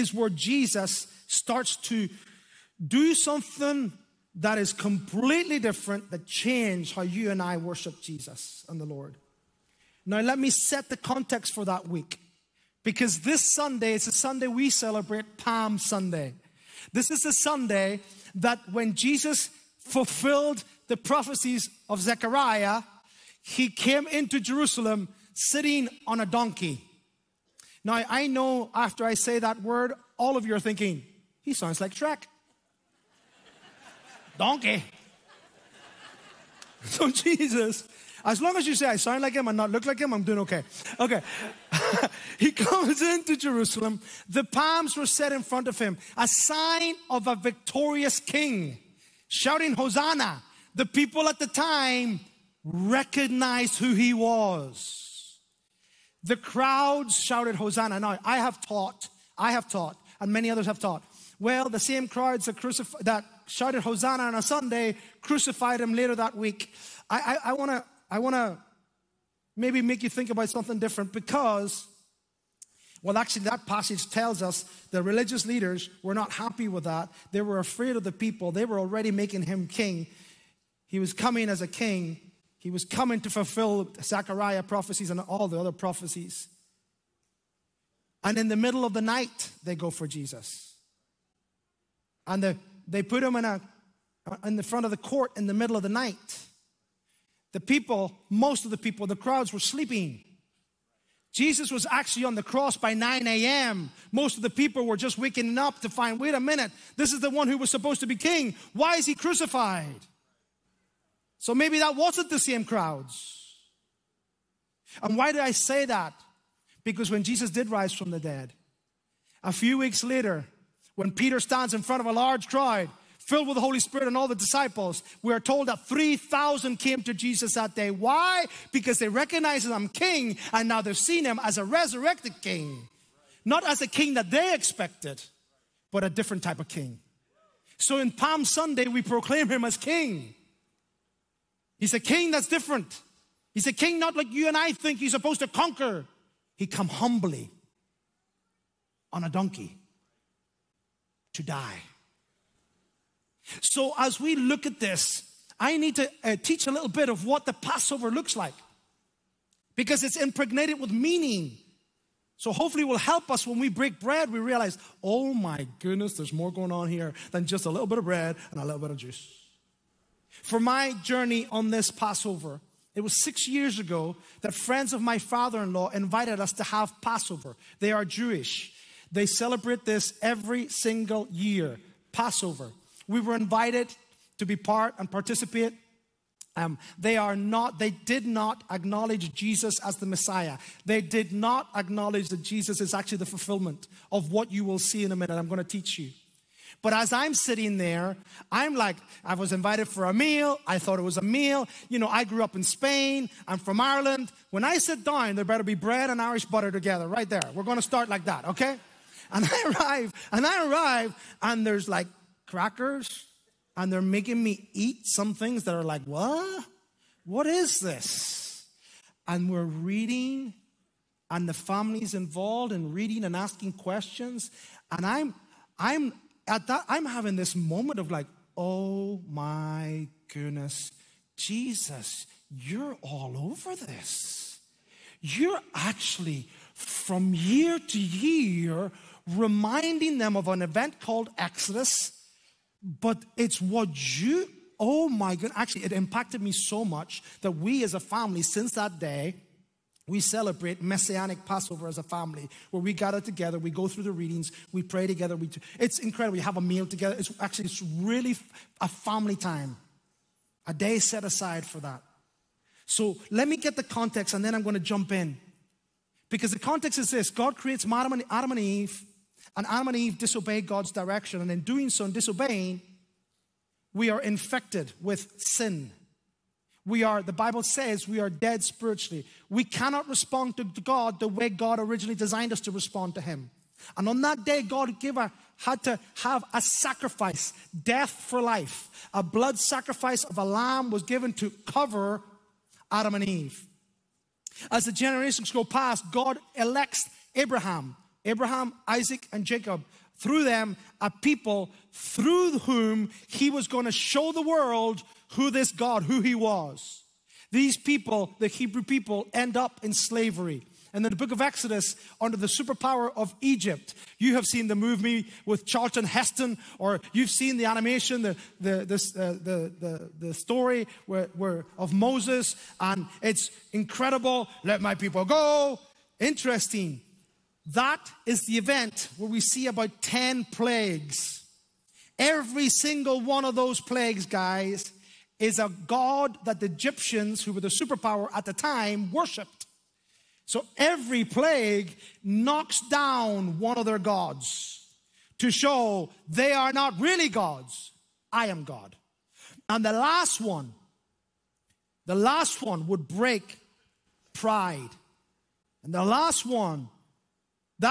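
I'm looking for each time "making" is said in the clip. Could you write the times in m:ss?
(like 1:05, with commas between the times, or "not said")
1:19, 3:34.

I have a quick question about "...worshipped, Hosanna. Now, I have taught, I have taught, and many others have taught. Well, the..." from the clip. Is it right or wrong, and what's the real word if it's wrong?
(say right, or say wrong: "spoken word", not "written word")
wrong: "shouted", not "worshipped".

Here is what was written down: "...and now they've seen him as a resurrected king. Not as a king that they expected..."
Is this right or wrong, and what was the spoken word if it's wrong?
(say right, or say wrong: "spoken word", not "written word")
right.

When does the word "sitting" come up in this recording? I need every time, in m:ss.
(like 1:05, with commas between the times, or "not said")
0:25, 3:17.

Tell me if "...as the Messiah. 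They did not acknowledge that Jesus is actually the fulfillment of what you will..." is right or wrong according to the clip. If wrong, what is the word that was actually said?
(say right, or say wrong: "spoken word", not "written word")
right.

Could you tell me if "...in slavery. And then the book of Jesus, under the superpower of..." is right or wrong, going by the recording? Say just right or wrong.
wrong.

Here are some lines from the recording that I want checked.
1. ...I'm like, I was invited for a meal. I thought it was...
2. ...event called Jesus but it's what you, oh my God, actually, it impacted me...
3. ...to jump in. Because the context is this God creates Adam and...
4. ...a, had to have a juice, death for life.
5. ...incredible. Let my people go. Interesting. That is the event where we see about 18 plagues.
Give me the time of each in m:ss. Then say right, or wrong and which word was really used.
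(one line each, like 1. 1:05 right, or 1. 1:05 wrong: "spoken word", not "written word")
1. 3:18 right
2. 4:00 wrong: "Exodus", not "Jesus"
3. 4:24 right
4. 4:45 wrong: "sacrifice", not "juice"
5. 5:23 wrong: "10", not "18".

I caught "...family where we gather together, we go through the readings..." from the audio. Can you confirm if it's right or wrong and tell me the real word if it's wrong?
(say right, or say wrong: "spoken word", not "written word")
right.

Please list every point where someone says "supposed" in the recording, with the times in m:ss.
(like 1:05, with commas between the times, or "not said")
1:47, 2:25.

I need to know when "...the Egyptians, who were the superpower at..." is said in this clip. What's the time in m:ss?
5:36.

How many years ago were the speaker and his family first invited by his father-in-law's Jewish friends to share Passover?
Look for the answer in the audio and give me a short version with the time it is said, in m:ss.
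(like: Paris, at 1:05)
6, at 2:53.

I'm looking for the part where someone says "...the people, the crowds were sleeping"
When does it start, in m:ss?
1:38.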